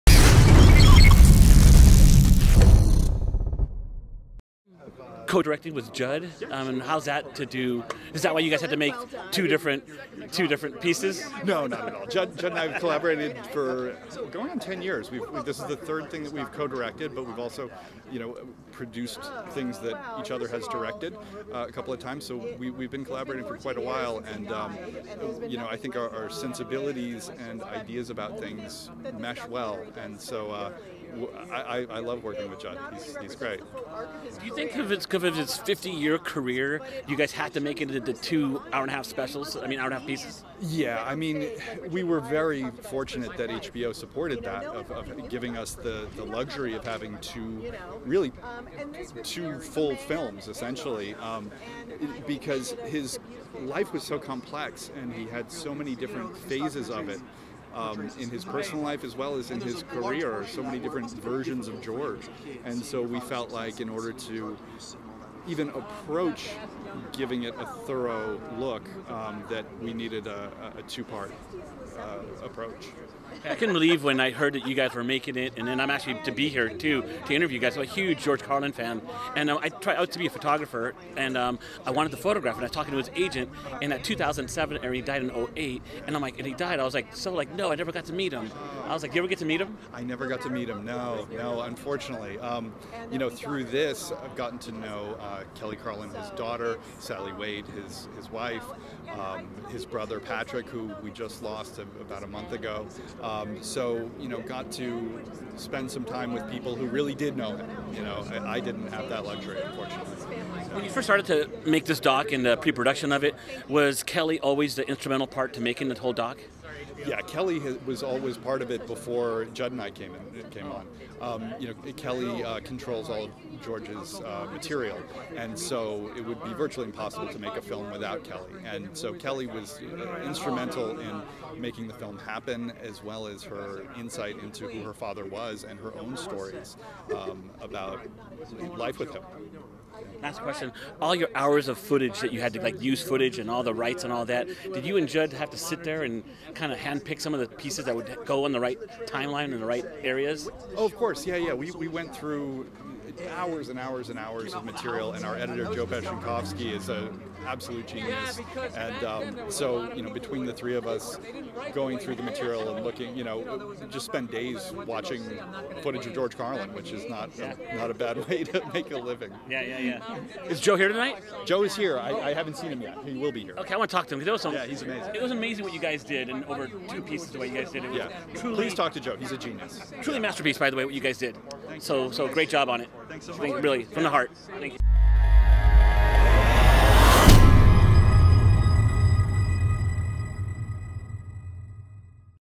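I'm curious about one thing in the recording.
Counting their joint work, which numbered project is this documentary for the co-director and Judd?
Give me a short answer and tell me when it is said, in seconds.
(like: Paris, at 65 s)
third, at 15 s.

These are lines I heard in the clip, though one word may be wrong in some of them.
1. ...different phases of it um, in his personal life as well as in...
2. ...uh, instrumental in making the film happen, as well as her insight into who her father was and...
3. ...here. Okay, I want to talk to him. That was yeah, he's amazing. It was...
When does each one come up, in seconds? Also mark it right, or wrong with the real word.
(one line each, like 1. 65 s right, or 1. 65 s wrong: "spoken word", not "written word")
1. 55 s right
2. 129 s right
3. 173 s right.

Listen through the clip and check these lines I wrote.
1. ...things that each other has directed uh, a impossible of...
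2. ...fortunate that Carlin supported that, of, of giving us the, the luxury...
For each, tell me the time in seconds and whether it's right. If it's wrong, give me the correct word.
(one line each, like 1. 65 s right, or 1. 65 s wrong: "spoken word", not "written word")
1. 19 s wrong: "couple", not "impossible"
2. 42 s wrong: "HBO", not "Carlin".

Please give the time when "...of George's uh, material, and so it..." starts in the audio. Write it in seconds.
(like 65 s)
123 s.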